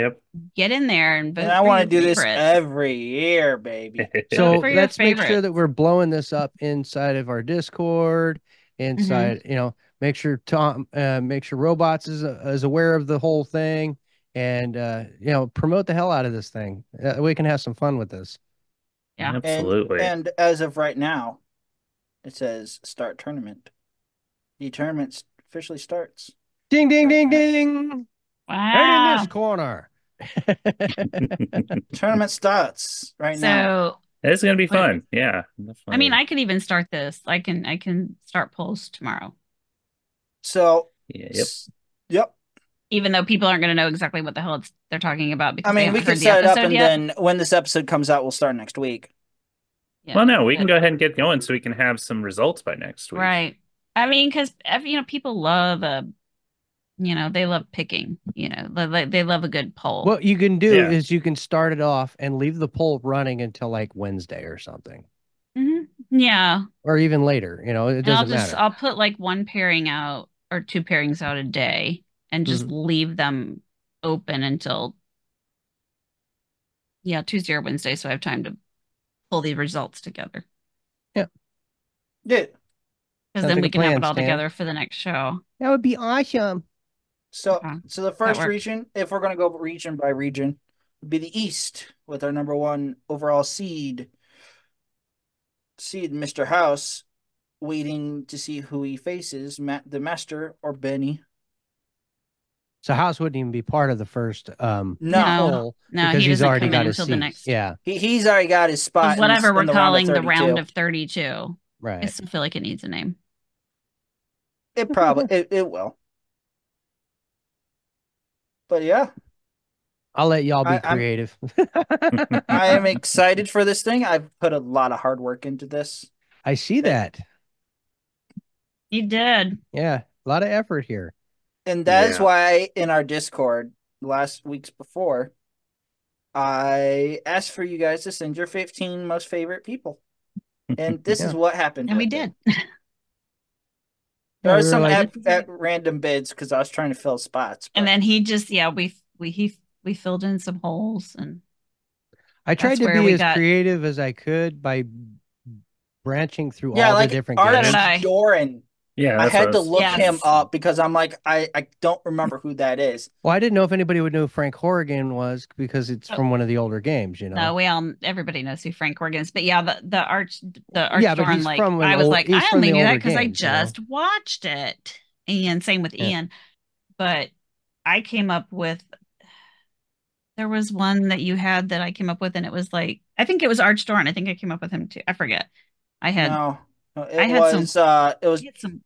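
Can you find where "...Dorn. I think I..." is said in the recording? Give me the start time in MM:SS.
03:03.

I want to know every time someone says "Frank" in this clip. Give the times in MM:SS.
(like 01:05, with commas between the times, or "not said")
02:44, 02:48.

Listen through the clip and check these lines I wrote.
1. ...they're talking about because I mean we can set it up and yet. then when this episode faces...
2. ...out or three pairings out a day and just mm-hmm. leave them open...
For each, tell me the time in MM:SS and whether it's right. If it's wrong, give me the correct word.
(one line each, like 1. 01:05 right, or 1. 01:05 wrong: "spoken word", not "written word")
1. 00:44 wrong: "comes", not "faces"
2. 01:09 wrong: "two", not "three".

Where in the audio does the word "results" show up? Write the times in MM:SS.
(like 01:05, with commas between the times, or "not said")
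00:52, 01:19.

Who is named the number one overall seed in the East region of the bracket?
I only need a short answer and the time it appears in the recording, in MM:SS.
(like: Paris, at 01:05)
Mr. House, at 01:36.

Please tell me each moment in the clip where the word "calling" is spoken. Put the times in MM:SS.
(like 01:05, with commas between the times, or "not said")
01:49.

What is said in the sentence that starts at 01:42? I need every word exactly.
So House wouldn't even be part of the first.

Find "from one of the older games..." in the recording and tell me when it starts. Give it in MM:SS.
02:46.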